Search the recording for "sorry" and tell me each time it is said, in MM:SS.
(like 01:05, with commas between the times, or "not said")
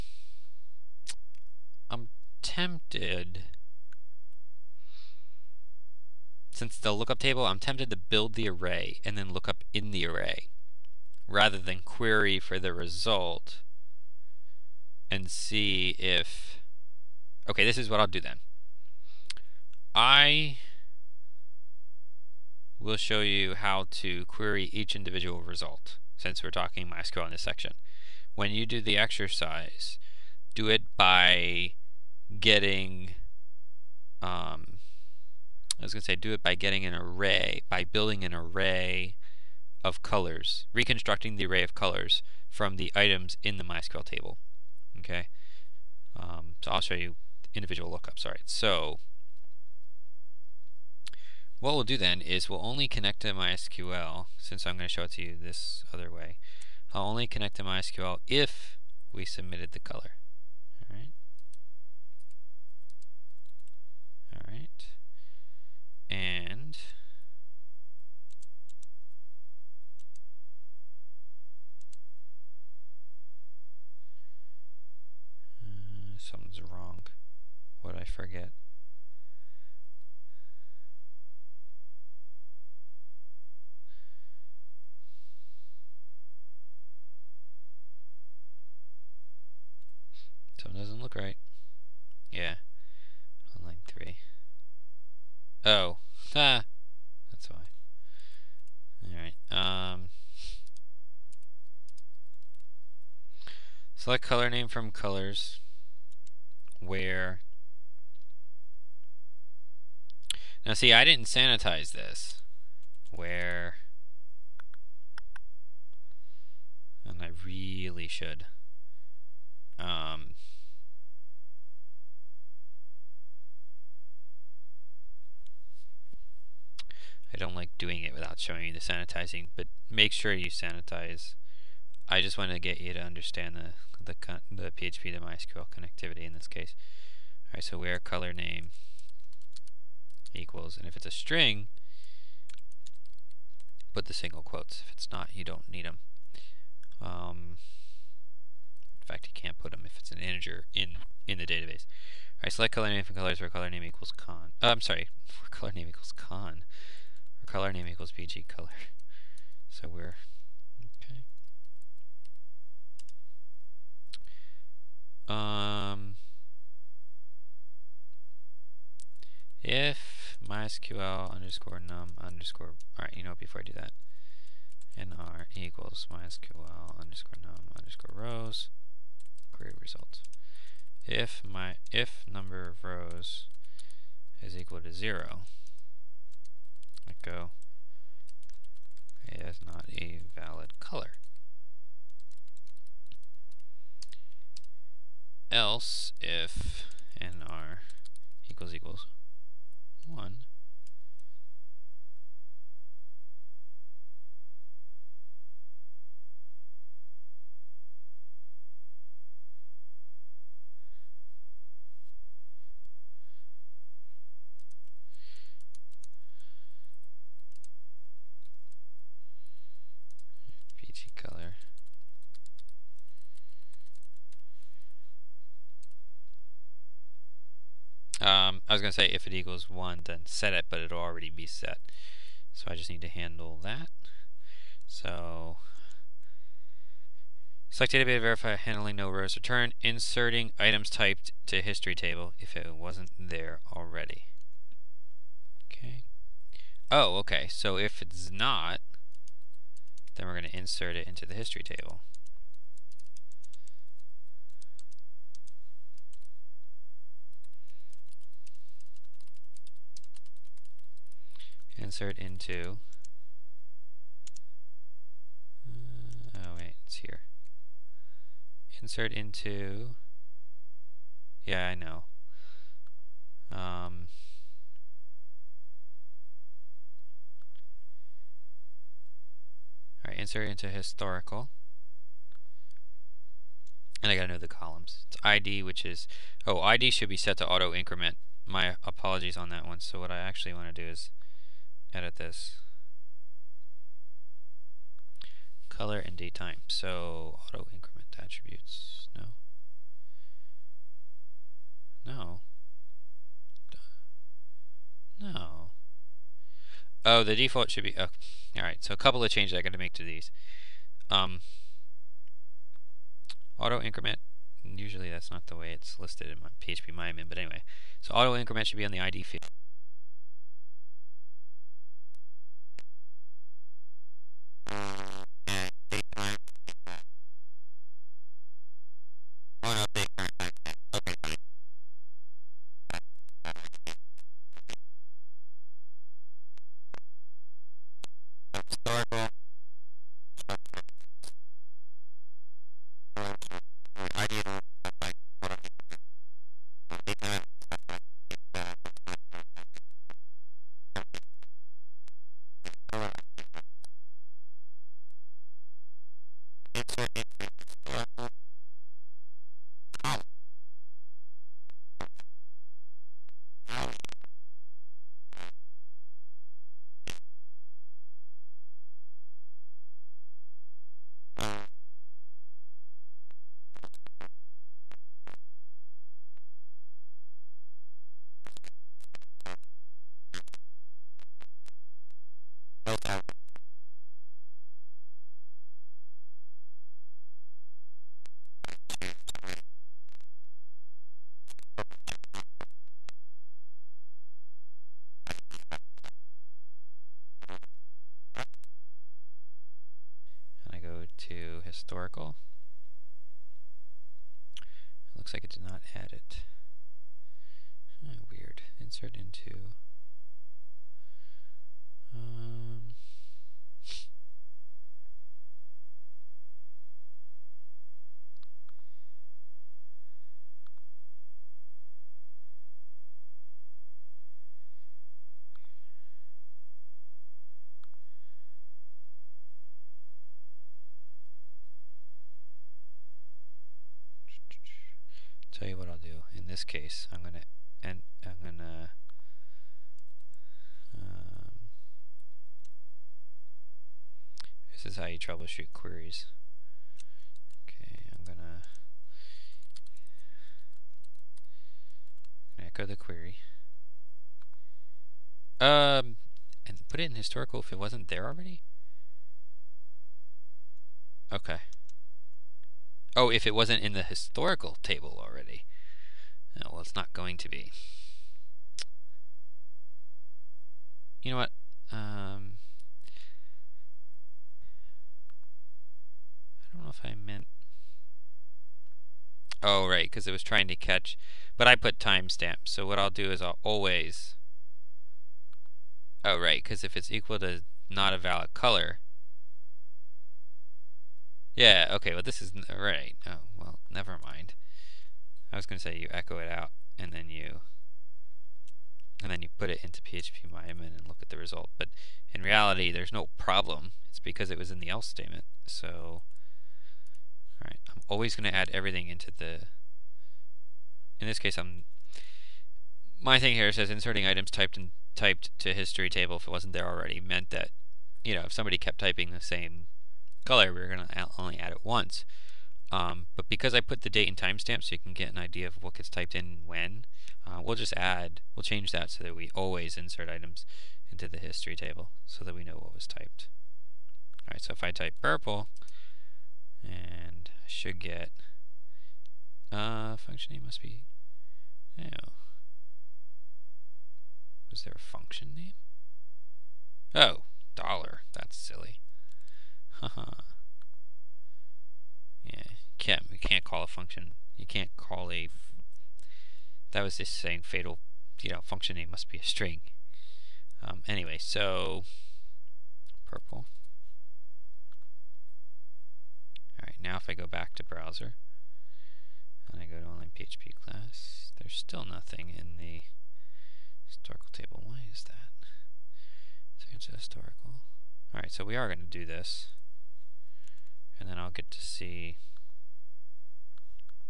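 02:34, 06:13.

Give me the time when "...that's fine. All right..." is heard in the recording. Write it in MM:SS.
05:35.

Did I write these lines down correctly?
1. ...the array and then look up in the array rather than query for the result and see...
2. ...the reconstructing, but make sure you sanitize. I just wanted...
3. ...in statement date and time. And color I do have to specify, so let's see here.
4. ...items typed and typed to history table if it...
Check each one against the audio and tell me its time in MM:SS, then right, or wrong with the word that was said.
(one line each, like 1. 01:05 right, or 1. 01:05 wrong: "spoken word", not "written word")
1. 00:08 right
2. 02:08 wrong: "sanitizing", not "reconstructing"
3. 05:50 wrong: "current", not "statement"
4. 08:34 right.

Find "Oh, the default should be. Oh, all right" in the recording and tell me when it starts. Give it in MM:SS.
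05:07.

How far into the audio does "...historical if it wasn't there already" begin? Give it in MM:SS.
07:37.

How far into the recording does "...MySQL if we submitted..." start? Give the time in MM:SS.
00:57.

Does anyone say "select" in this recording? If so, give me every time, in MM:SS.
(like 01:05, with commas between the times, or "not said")
01:43, 02:32, 03:57.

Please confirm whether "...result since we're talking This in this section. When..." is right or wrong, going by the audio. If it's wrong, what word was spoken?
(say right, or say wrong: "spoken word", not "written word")
wrong: "MySQL", not "This".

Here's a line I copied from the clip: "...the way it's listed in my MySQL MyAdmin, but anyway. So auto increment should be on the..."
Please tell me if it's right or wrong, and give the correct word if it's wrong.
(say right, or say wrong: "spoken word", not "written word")
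wrong: "PHP", not "MySQL".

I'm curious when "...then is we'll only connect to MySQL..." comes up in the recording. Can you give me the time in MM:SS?
00:51.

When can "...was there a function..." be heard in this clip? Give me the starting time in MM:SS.
09:04.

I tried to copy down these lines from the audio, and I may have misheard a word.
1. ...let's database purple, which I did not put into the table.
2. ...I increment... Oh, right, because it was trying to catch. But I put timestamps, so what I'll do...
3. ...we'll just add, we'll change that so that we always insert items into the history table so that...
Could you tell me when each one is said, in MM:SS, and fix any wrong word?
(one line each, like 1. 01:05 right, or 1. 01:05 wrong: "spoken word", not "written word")
1. 06:31 wrong: "choose", not "database"
2. 07:57 wrong: "meant", not "increment"
3. 08:47 right.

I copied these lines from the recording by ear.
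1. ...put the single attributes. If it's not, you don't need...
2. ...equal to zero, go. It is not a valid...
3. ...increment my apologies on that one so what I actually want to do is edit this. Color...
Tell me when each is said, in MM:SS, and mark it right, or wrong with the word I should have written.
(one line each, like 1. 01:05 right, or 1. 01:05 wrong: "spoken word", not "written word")
1. 02:23 wrong: "quotes", not "attributes"
2. 03:04 right
3. 04:47 right.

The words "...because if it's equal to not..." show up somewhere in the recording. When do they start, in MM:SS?
08:06.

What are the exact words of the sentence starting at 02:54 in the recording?
nr equals mysql underscore num underscore rows query result.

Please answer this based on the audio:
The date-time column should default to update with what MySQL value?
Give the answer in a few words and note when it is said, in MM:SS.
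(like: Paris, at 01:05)
current timestamp, at 05:30.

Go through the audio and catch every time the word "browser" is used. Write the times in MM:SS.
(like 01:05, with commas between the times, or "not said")
06:38, 09:27.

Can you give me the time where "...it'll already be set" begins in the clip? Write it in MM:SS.
03:50.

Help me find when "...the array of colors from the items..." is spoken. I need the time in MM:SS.
00:41.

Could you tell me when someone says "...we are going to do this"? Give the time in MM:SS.
09:38.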